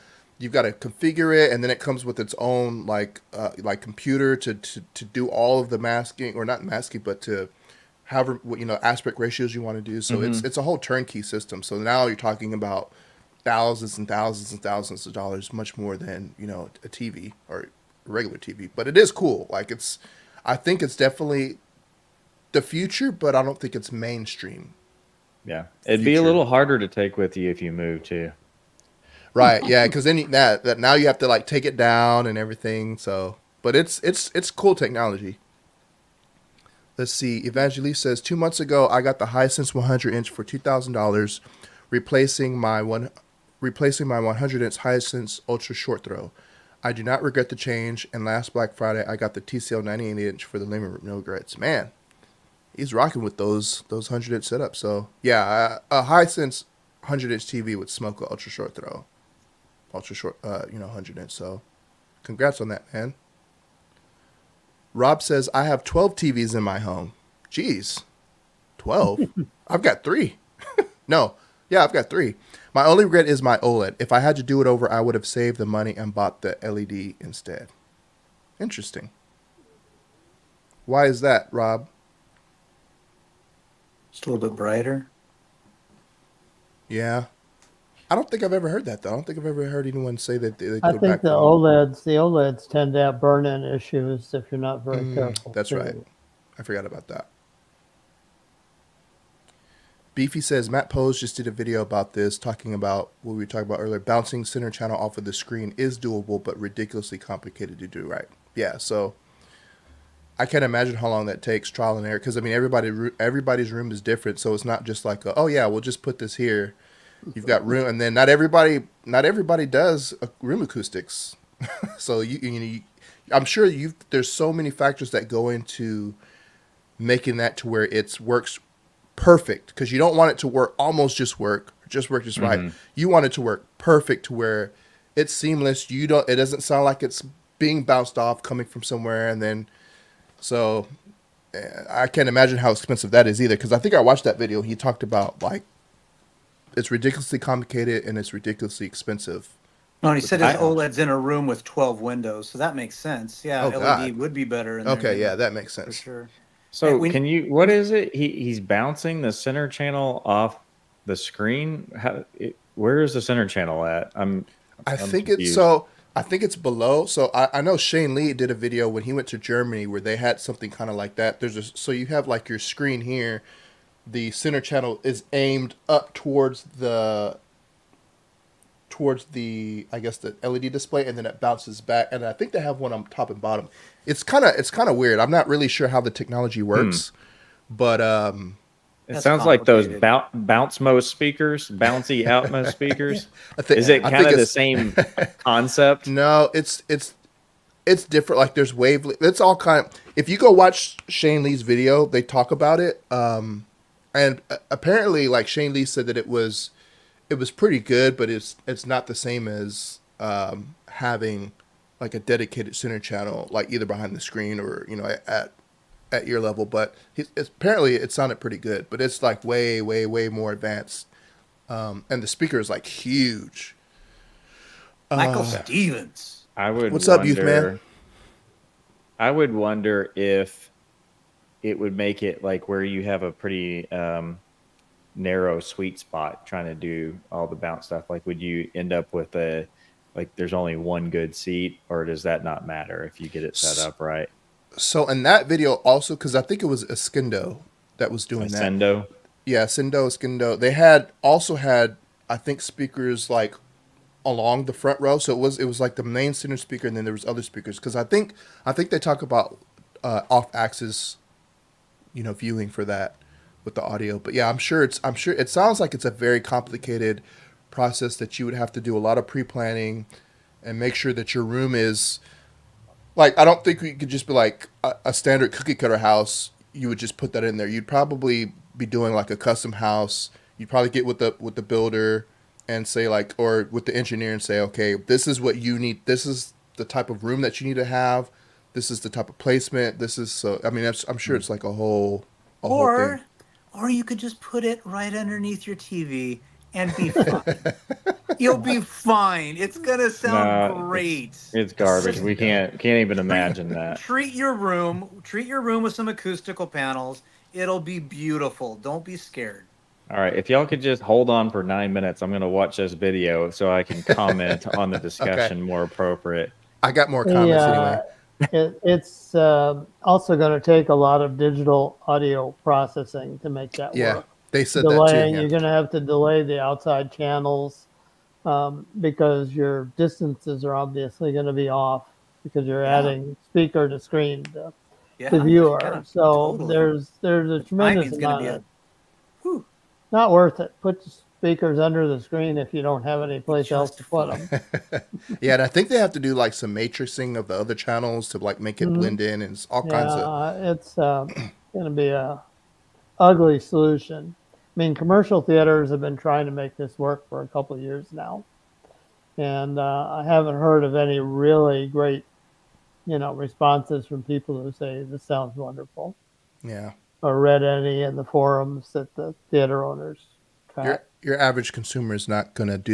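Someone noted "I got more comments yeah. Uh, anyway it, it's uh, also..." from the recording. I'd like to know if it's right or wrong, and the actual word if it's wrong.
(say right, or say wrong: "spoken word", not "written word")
right.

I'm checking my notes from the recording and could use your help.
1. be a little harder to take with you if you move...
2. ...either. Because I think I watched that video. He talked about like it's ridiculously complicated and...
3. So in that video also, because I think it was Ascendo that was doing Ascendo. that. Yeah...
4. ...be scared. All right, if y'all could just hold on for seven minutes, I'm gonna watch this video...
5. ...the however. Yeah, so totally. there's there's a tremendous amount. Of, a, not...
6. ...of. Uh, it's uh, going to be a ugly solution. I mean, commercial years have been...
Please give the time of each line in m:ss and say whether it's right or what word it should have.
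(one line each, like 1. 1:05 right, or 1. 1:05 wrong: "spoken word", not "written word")
1. 0:26 right
2. 2:23 right
3. 4:04 right
4. 5:09 wrong: "nine", not "seven"
5. 5:35 wrong: "viewer", not "however"
6. 5:50 wrong: "theaters", not "years".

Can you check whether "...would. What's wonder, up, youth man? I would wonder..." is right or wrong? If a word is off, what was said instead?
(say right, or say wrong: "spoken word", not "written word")
right.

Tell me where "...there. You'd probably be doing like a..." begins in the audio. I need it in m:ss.
4:37.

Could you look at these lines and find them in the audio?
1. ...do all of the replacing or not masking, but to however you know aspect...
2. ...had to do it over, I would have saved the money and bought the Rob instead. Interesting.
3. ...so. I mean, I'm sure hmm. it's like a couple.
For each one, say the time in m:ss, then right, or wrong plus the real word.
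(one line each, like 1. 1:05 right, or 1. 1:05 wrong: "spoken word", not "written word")
1. 0:05 wrong: "masking", not "replacing"
2. 1:14 wrong: "LED", not "Rob"
3. 4:50 wrong: "whole", not "couple".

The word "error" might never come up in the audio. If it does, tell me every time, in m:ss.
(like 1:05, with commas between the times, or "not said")
1:52.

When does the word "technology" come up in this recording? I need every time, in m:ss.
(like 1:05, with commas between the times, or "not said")
0:34, 3:06.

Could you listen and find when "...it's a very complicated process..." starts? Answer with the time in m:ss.
4:25.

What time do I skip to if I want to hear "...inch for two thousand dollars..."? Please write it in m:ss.
0:40.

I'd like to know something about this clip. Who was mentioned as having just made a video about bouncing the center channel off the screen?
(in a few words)
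Matt Poes.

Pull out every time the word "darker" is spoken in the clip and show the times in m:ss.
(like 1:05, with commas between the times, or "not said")
not said.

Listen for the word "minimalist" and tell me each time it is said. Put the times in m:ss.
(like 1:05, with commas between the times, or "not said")
not said.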